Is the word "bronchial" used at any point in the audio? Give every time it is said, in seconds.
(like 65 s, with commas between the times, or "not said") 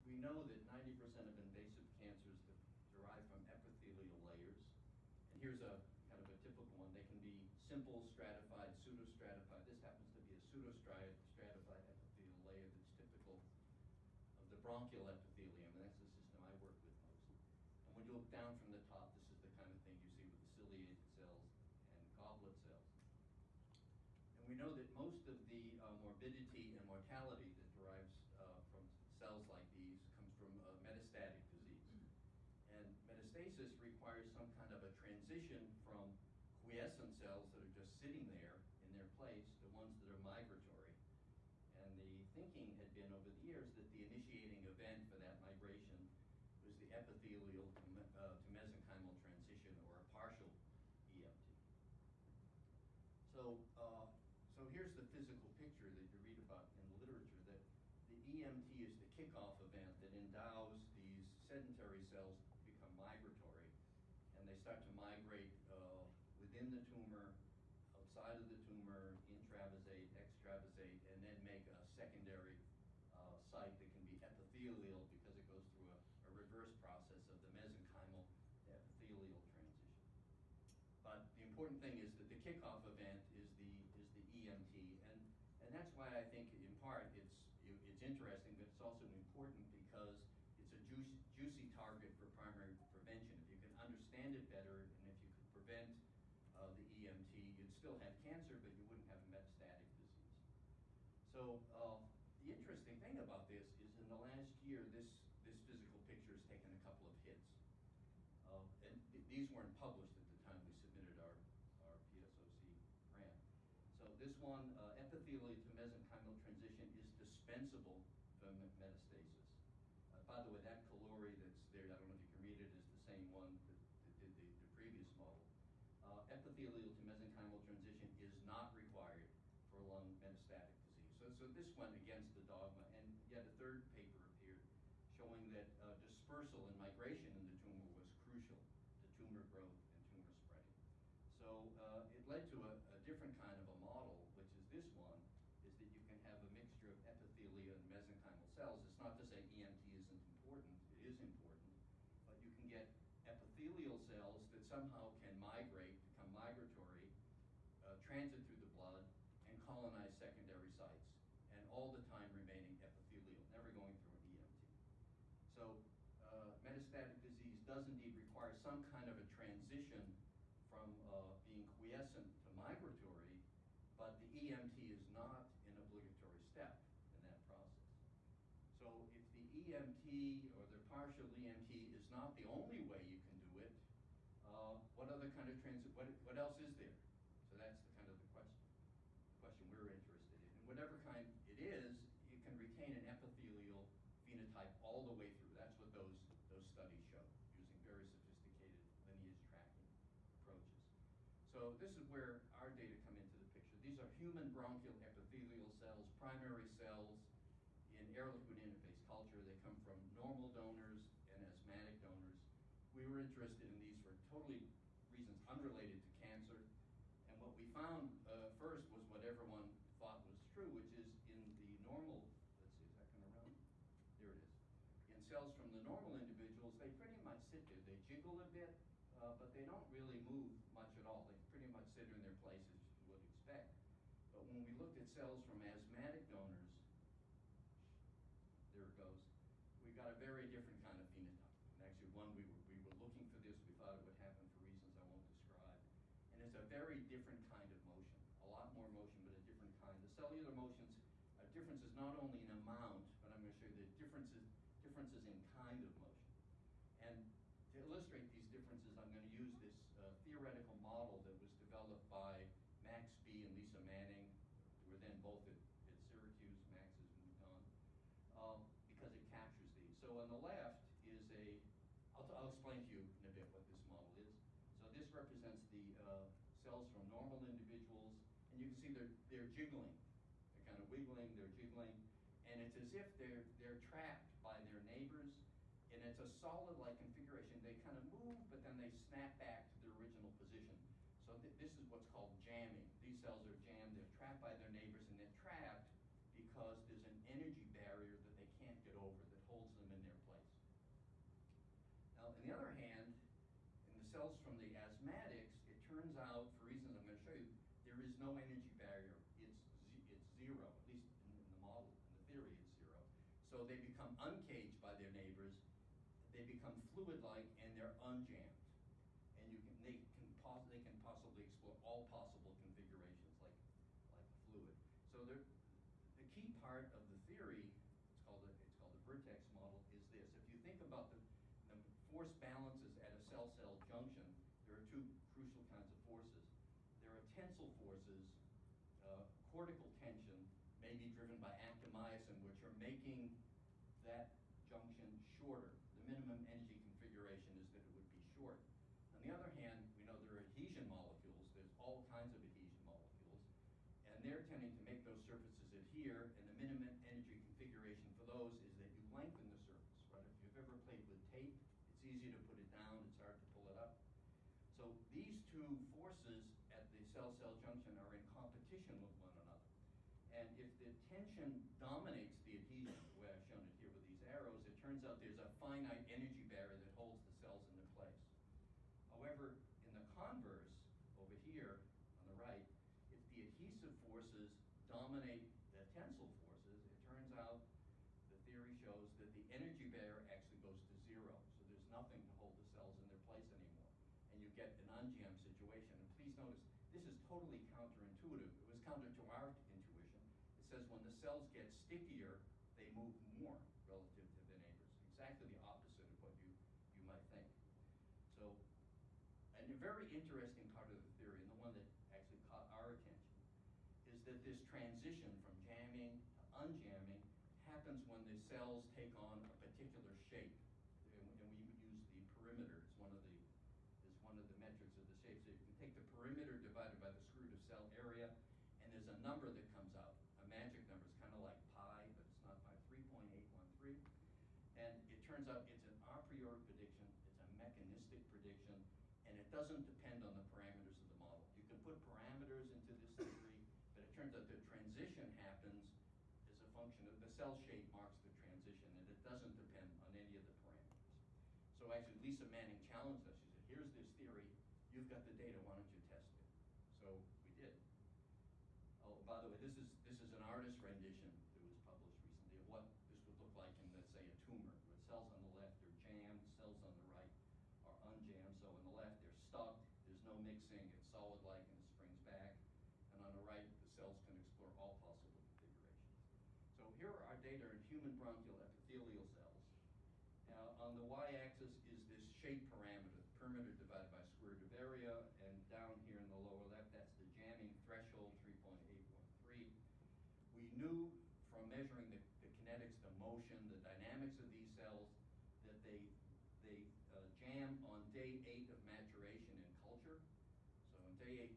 14 s, 204 s, 478 s.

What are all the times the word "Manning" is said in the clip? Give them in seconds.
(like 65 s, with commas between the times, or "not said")
263 s, 452 s.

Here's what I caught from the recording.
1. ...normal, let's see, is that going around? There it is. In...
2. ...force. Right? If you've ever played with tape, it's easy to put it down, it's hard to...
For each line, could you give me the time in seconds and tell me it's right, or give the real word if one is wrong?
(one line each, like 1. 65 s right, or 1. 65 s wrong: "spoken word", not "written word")
1. 221 s right
2. 359 s wrong: "surface", not "force".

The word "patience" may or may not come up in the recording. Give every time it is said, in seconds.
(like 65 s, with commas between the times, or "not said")
not said.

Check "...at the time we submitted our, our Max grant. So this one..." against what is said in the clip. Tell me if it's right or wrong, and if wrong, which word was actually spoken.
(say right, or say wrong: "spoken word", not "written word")
wrong: "PSOC", not "Max".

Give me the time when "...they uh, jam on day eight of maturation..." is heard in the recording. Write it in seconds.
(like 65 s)
496 s.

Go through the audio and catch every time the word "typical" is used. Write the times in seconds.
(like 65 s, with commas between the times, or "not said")
6 s, 12 s.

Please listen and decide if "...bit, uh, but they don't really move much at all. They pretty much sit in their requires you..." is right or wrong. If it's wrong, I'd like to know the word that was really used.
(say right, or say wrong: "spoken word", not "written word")
wrong: "places", not "requires".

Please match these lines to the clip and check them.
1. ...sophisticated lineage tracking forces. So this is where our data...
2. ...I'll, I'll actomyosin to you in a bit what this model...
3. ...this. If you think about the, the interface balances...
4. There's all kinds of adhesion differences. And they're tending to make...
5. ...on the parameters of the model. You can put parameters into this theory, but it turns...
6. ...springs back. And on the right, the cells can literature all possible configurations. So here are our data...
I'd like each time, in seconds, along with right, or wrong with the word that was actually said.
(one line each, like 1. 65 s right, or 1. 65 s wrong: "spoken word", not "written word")
1. 198 s wrong: "approaches", not "forces"
2. 272 s wrong: "explain", not "actomyosin"
3. 330 s wrong: "force", not "interface"
4. 351 s wrong: "molecules", not "differences"
5. 440 s right
6. 471 s wrong: "explore", not "literature".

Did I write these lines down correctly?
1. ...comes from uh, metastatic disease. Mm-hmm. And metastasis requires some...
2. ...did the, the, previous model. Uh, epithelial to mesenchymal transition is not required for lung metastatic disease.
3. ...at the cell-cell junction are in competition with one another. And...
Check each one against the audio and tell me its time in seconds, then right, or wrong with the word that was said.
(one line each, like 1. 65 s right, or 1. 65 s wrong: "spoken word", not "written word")
1. 30 s right
2. 124 s right
3. 366 s right.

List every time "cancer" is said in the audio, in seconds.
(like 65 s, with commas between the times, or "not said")
1 s, 98 s, 216 s.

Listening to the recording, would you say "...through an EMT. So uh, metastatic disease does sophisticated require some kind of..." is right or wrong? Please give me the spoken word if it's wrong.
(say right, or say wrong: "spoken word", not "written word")
wrong: "indeed", not "sophisticated".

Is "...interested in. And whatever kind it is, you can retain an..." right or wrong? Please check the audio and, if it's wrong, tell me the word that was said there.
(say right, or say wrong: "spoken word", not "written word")
right.